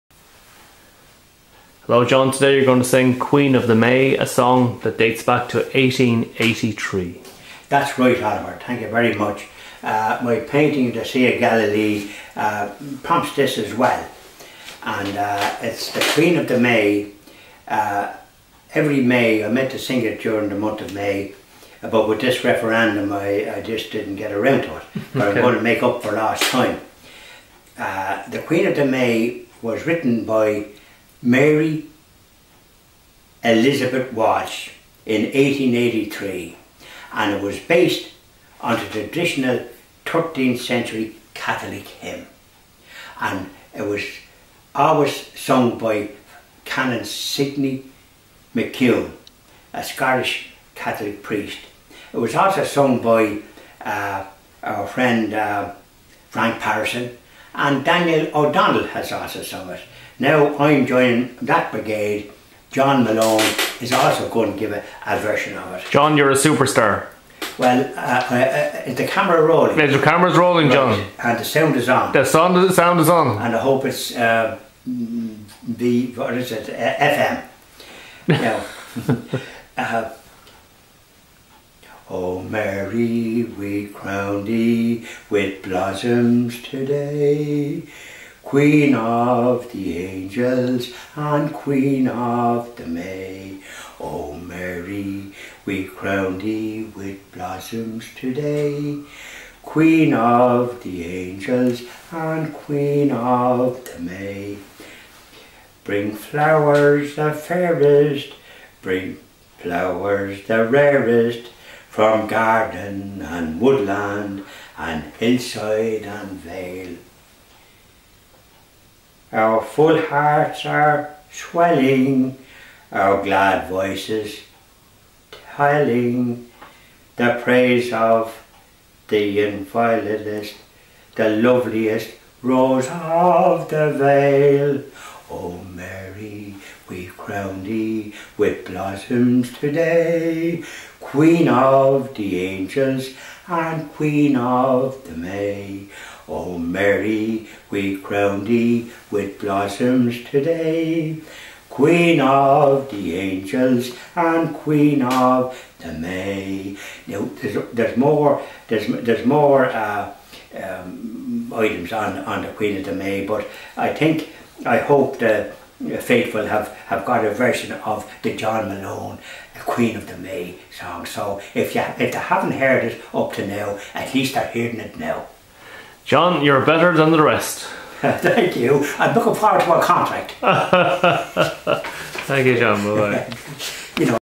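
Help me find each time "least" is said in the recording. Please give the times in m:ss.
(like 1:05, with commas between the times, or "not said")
2:54.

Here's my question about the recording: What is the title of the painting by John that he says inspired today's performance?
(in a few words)
The Sea of Galilee.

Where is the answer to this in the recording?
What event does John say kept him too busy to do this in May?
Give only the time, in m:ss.
0:22.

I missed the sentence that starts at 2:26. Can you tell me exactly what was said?
O oh, Mary, we crown thee with blossoms today.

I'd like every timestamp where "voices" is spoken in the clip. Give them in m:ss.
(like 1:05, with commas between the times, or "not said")
2:03.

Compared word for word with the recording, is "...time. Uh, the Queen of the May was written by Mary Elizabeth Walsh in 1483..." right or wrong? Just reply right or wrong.
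wrong.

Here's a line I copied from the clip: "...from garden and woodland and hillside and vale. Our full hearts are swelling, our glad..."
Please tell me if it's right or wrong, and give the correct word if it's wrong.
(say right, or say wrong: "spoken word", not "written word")
right.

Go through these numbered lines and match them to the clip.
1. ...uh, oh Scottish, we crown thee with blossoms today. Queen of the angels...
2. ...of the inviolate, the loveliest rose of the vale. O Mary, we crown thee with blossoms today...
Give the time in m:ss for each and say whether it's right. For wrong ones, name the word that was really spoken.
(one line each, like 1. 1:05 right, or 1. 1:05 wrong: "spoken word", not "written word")
1. 1:19 wrong: "Mary", not "Scottish"
2. 2:07 right.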